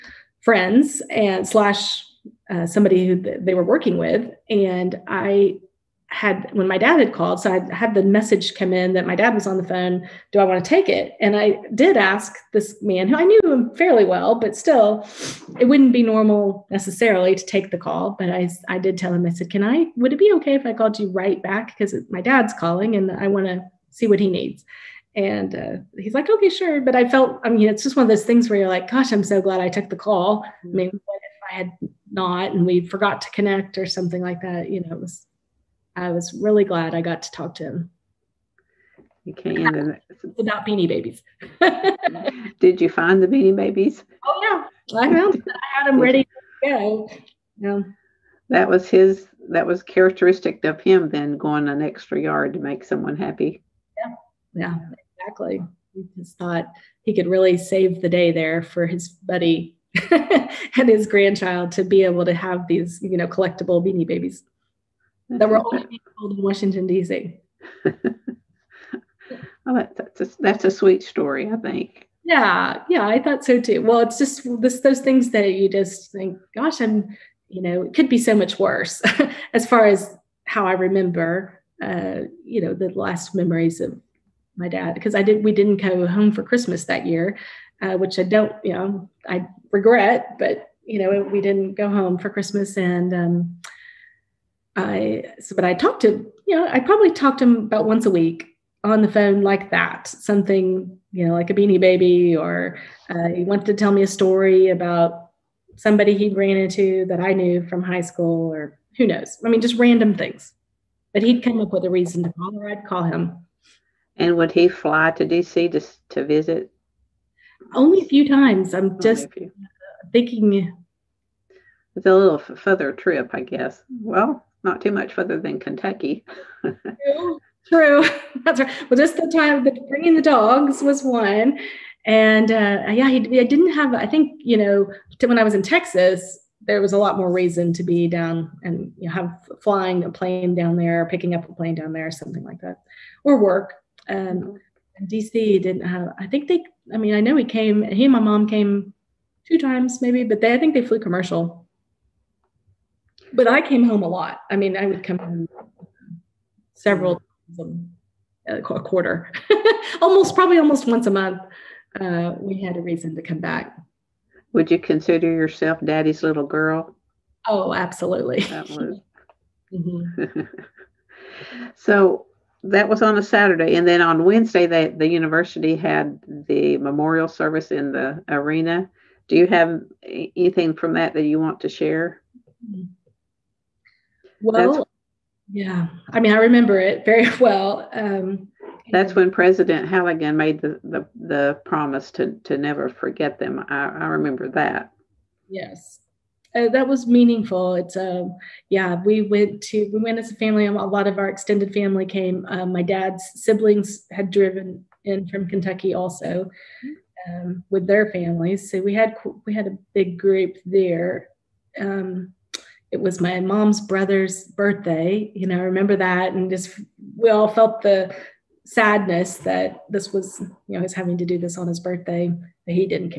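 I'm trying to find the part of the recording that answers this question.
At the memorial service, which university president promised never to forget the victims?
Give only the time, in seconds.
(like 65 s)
189 s.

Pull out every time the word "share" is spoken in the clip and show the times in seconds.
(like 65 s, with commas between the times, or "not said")
181 s.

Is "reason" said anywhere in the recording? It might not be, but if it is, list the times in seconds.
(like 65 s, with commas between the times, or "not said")
111 s, 137 s, 162 s.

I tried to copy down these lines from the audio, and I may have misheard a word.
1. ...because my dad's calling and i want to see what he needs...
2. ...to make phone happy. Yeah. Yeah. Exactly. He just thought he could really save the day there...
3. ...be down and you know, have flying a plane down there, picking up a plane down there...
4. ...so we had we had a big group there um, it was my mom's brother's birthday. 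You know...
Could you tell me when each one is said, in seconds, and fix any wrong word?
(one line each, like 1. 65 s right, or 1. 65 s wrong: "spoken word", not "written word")
1. 21 s right
2. 52 s wrong: "someone", not "phone"
3. 137 s right
4. 208 s right.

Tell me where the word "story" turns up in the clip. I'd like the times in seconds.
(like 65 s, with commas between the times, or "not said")
71 s, 104 s.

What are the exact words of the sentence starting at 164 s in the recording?
Would you consider yourself daddy's little girl?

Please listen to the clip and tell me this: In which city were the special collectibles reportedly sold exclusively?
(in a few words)
Washington D.C.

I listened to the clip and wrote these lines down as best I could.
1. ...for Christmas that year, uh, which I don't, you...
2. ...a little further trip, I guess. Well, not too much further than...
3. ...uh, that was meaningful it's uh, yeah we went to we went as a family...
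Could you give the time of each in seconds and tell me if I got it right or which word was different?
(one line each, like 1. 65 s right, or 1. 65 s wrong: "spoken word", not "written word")
1. 86 s right
2. 122 s right
3. 196 s right.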